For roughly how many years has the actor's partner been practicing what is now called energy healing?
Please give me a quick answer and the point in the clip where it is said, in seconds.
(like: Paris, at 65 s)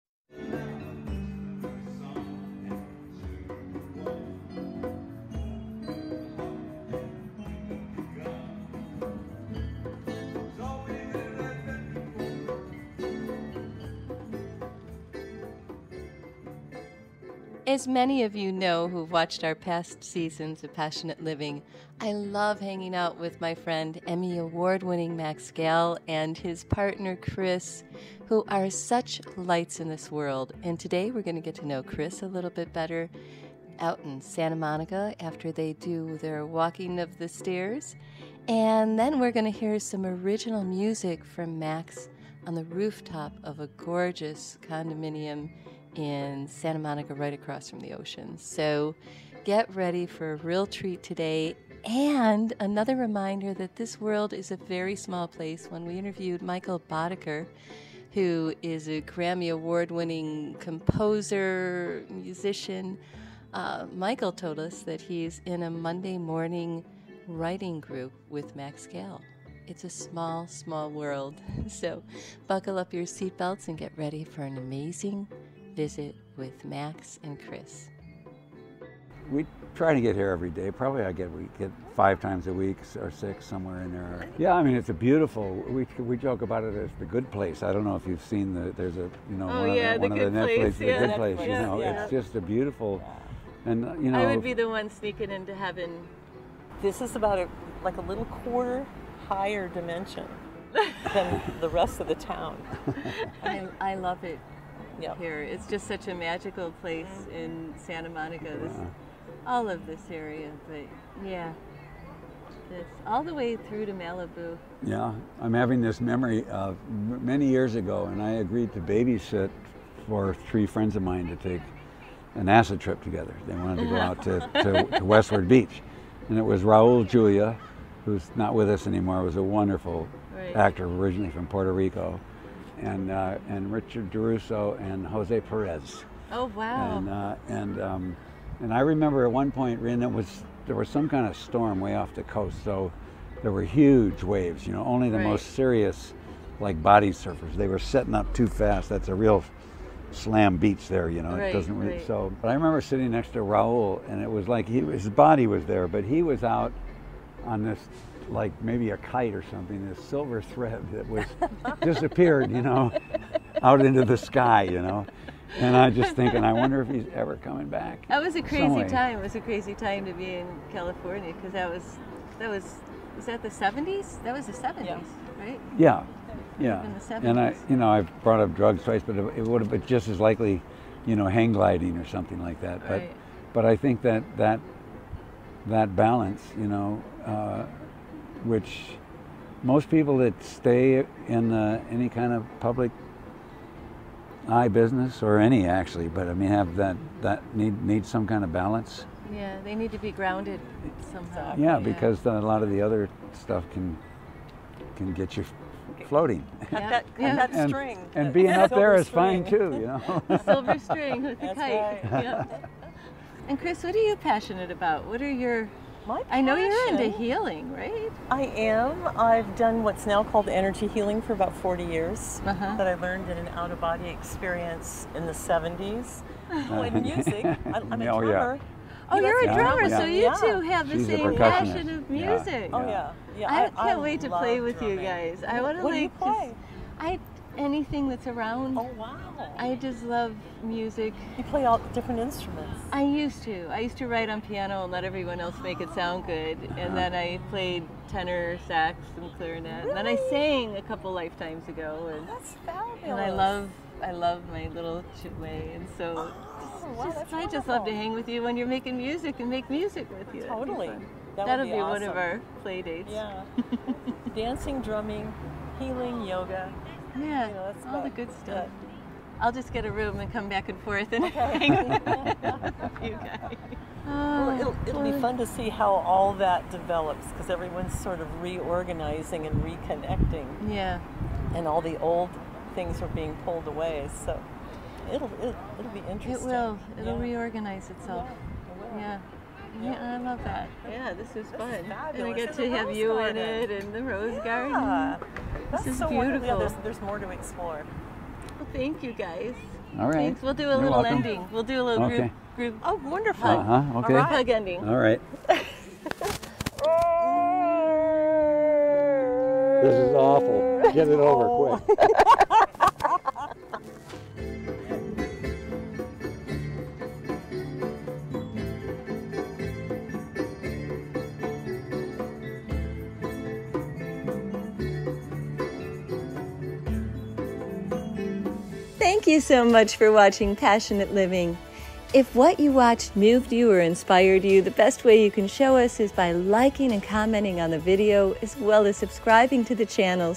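40 years, at 221 s.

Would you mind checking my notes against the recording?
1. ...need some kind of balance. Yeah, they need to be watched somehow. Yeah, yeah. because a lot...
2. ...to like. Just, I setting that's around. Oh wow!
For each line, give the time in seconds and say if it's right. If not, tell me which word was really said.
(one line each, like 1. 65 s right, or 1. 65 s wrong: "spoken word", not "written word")
1. 197 s wrong: "grounded", not "watched"
2. 235 s wrong: "anything", not "setting".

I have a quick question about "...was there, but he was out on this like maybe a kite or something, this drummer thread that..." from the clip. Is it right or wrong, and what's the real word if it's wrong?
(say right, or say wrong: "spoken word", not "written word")
wrong: "silver", not "drummer".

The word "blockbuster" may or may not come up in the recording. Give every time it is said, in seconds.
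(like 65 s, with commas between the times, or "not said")
not said.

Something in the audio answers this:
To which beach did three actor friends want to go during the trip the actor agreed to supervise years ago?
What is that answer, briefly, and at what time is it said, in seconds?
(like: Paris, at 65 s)
Westward Beach, at 125 s.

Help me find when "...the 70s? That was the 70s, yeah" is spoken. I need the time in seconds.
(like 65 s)
173 s.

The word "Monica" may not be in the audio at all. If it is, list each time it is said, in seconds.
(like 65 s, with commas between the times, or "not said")
34 s, 46 s, 108 s.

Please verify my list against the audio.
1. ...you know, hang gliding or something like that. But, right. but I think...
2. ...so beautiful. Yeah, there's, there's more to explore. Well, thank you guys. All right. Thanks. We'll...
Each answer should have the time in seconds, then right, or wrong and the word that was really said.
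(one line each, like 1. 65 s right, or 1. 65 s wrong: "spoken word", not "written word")
1. 181 s right
2. 295 s right.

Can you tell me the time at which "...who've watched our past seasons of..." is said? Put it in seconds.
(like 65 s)
18 s.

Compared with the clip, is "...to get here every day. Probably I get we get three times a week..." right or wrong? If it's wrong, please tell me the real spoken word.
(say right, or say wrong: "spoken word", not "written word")
wrong: "five", not "three".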